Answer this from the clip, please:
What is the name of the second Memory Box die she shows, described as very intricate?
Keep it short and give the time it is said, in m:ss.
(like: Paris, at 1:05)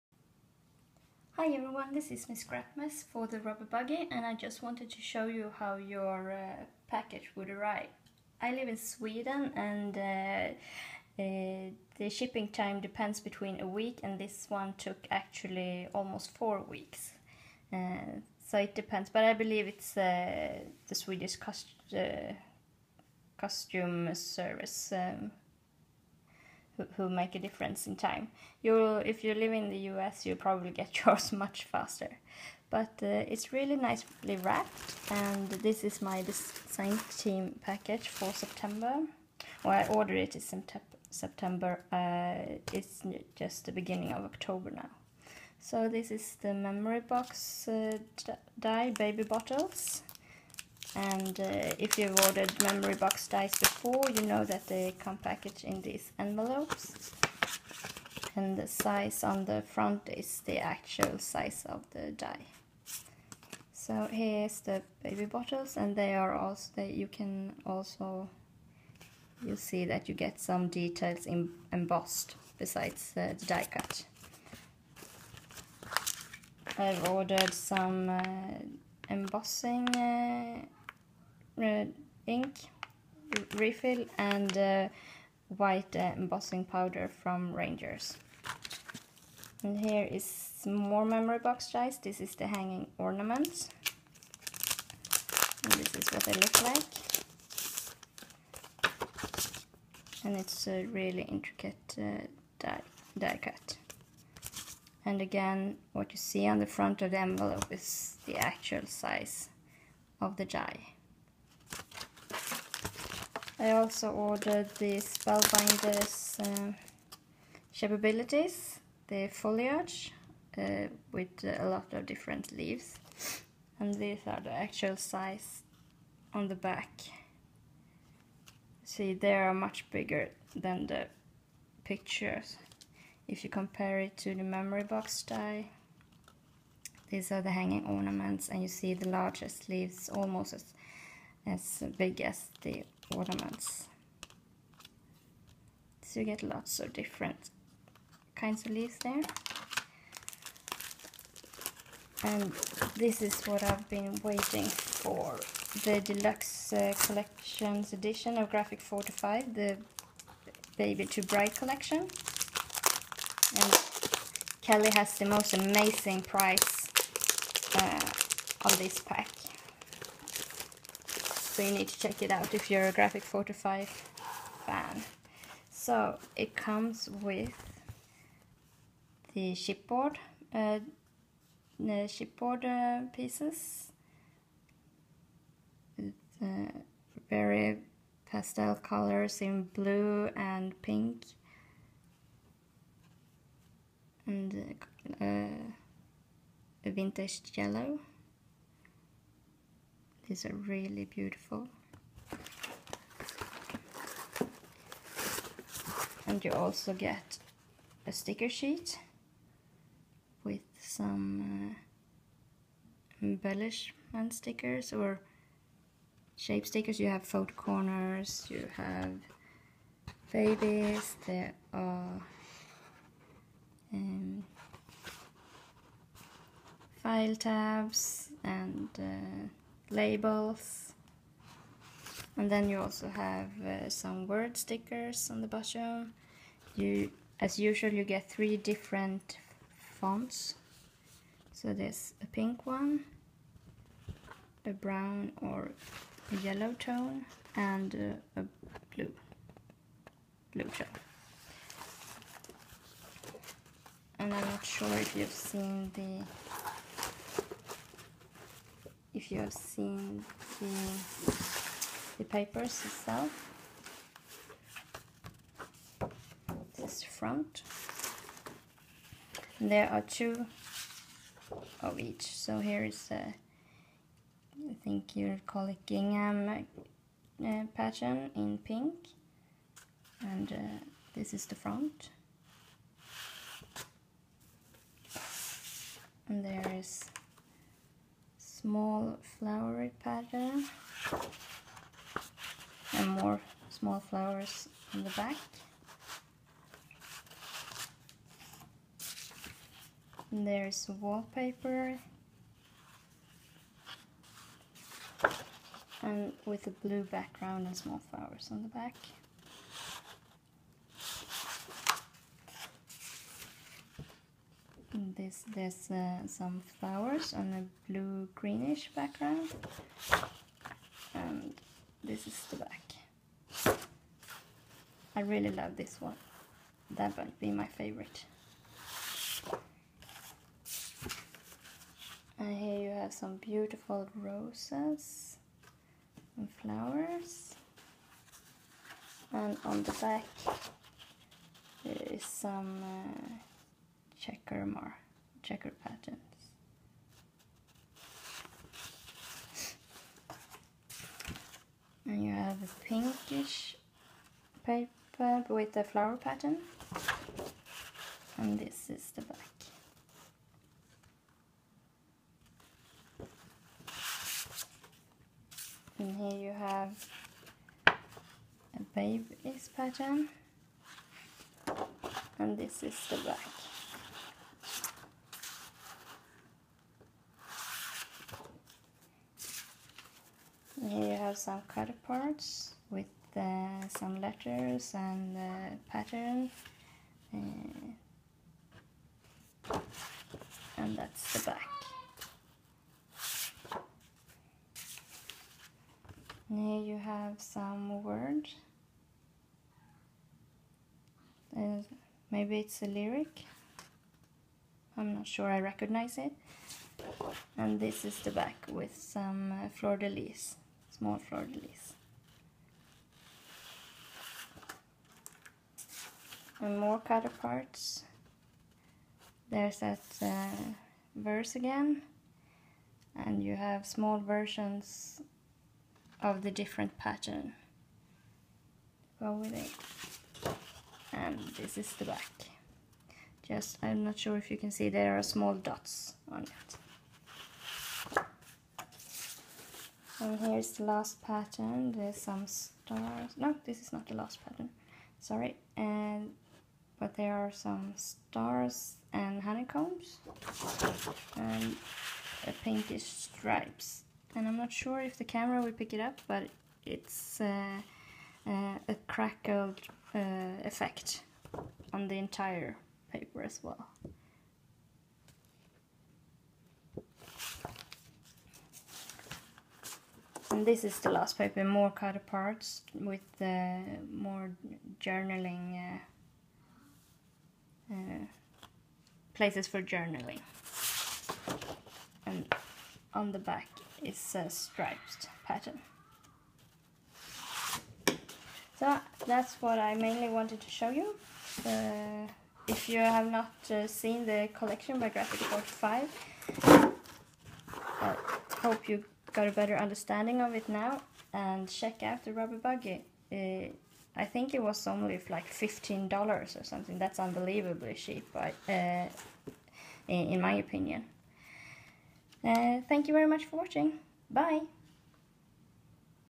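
hanging ornament, at 1:32.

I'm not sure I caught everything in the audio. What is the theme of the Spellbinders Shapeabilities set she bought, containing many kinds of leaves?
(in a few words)
foliage.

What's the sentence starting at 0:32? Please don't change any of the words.
But uh, it's really nicely wrapped, and this is my design team package for September.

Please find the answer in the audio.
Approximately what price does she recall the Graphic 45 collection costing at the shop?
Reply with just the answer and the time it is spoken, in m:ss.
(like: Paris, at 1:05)
$15, at 8:25.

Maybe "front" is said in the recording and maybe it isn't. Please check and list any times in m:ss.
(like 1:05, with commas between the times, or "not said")
0:59, 1:46, 4:27, 4:41.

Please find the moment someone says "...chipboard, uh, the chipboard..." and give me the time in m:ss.
2:59.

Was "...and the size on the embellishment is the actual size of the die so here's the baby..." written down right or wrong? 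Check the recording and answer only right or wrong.
wrong.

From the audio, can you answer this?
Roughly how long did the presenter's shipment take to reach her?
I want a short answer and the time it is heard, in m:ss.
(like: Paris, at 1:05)
almost 4 weeks, at 0:15.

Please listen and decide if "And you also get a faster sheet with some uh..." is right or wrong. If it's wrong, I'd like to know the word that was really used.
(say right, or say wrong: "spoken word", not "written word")
wrong: "sticker", not "faster".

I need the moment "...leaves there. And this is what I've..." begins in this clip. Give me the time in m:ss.
2:28.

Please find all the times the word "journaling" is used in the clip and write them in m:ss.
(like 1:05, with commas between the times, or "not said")
7:55, 7:59.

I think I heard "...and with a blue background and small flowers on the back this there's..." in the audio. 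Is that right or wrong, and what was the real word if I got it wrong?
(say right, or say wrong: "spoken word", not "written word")
right.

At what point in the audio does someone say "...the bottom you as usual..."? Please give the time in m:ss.
3:55.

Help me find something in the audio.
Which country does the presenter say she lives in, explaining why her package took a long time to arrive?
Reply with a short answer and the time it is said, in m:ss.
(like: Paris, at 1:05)
Sweden, at 0:08.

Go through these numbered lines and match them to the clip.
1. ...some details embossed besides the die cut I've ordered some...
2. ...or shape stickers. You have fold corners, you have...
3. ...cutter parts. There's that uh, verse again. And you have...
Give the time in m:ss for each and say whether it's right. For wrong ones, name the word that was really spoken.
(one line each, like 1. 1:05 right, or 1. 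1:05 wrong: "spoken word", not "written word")
1. 1:10 right
2. 3:34 right
3. 6:56 right.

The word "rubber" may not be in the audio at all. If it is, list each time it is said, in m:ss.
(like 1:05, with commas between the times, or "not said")
0:03, 8:22.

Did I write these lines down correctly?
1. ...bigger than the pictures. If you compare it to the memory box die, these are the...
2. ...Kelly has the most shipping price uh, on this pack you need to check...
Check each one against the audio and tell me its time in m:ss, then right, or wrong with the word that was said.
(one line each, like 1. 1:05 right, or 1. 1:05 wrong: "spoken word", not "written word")
1. 2:09 right
2. 2:44 wrong: "amazing", not "shipping".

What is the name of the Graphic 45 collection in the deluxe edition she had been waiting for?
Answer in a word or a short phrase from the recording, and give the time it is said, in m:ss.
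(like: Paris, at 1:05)
Baby to Bride, at 2:40.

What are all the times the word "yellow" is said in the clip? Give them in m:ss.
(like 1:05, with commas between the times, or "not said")
3:17, 4:06.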